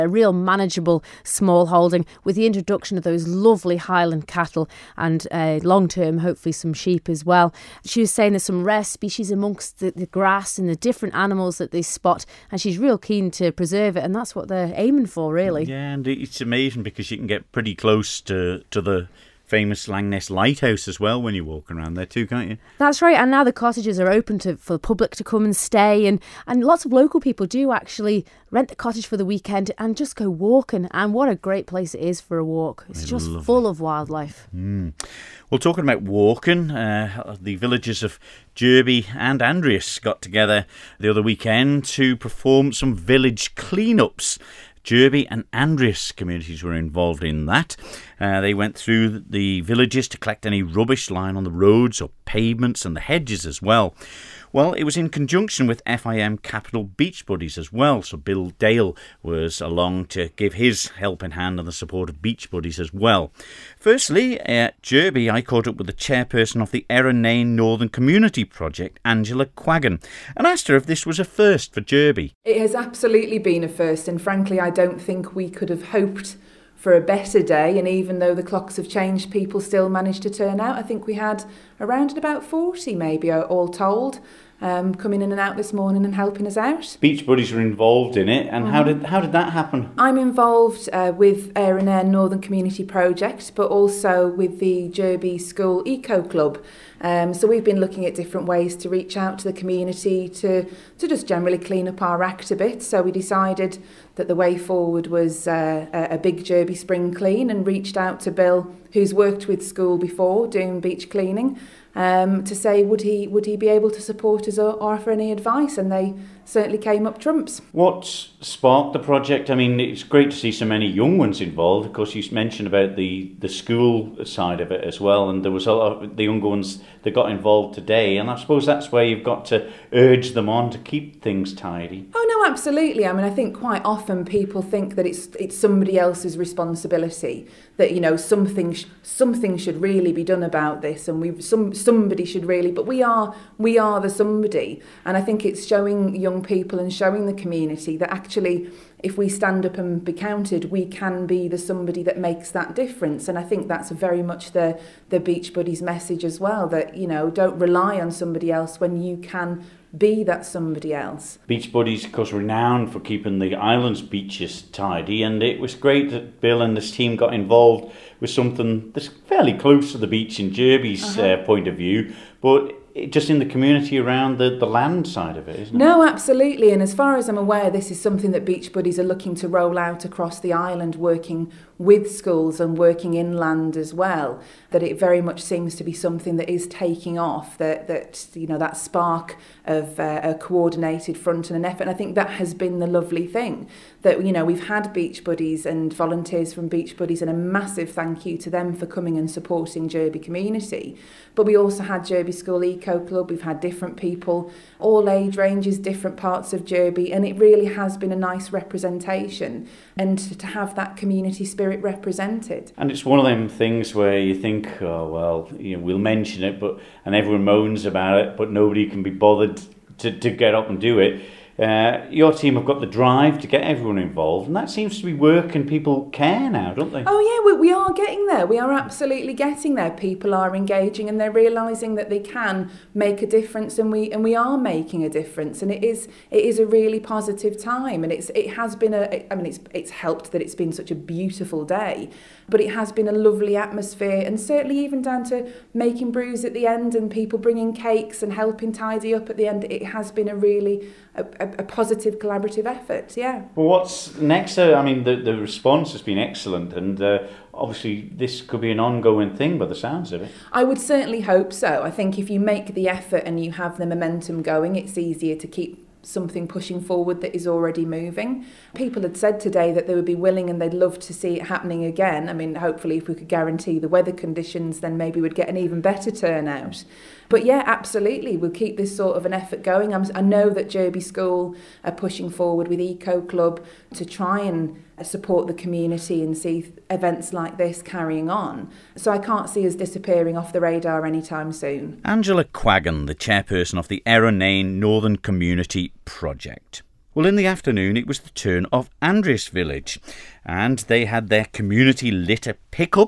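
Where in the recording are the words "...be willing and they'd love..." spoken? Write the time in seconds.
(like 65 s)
270 s.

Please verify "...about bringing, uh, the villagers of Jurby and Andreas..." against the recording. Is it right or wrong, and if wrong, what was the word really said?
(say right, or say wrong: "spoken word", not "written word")
wrong: "walking", not "bringing".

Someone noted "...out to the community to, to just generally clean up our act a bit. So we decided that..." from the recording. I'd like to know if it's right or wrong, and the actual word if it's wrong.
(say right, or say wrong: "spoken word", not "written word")
right.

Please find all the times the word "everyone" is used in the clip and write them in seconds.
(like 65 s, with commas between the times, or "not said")
217 s, 223 s.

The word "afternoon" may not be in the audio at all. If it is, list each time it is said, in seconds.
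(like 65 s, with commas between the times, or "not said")
297 s.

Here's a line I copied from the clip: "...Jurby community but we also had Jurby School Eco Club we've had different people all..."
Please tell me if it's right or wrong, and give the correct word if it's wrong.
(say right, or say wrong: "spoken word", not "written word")
right.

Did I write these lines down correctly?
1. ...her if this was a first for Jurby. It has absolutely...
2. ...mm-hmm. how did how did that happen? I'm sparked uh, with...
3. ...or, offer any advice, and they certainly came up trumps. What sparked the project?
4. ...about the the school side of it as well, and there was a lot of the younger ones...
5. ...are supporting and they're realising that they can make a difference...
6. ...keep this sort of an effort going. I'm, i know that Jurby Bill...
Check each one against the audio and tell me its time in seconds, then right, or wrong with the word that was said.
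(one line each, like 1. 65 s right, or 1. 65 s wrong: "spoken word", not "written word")
1. 70 s right
2. 88 s wrong: "involved", not "sparked"
3. 114 s right
4. 122 s right
5. 230 s wrong: "engaging", not "supporting"
6. 278 s wrong: "School", not "Bill".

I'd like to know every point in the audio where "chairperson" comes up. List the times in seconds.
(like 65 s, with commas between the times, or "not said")
65 s, 293 s.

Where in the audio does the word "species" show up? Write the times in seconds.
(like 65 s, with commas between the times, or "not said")
8 s.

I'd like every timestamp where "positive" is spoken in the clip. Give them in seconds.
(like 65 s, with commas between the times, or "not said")
236 s, 251 s.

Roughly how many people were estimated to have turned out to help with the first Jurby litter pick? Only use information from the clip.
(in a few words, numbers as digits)
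40.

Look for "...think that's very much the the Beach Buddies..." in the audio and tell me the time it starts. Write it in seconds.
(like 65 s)
153 s.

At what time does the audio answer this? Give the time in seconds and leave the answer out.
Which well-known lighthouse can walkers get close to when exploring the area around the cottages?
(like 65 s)
19 s.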